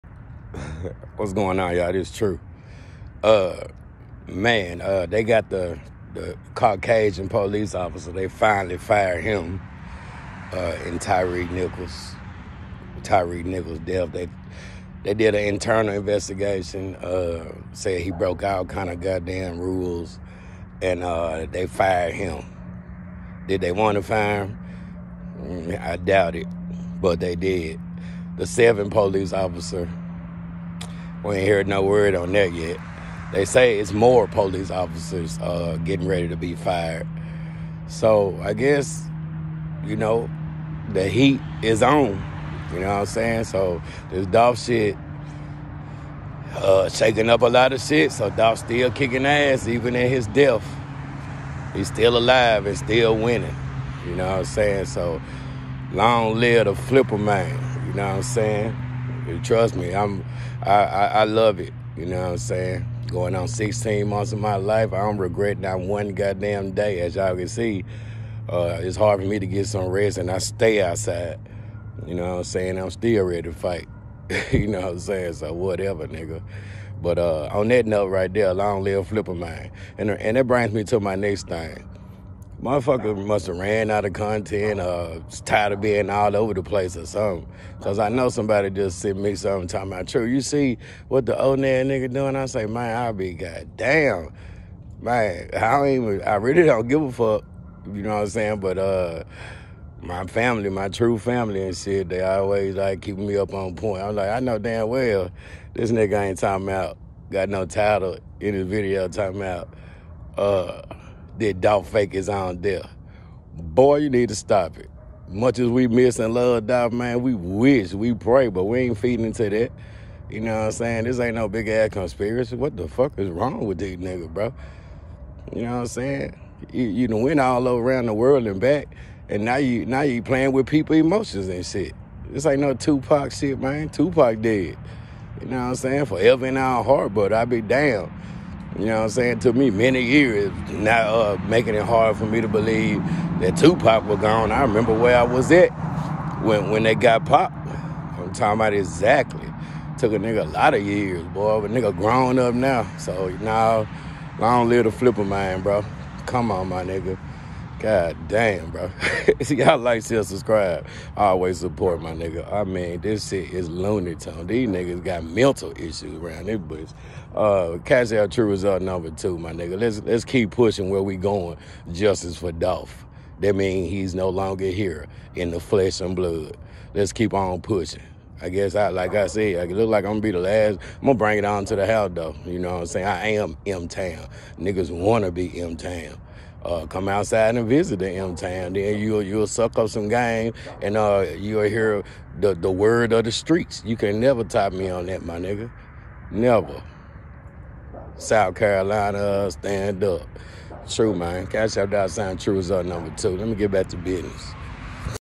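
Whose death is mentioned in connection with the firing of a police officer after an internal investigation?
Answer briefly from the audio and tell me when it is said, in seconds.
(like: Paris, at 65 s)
Tyre Nichols, at 13 s.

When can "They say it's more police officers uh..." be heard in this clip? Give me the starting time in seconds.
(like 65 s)
33 s.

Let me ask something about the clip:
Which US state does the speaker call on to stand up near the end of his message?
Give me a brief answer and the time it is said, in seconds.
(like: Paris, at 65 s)
South Carolina, at 198 s.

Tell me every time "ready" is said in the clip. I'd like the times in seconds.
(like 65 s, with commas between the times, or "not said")
36 s, 73 s.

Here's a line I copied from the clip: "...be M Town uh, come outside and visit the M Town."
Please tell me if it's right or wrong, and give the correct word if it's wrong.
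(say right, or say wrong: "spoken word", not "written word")
right.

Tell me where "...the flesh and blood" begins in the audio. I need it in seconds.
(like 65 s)
175 s.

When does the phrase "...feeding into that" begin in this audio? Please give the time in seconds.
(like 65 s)
118 s.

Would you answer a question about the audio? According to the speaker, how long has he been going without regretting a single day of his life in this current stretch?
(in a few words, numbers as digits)
16 months.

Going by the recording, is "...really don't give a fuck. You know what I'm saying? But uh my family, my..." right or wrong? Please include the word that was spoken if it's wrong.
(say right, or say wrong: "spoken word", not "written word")
right.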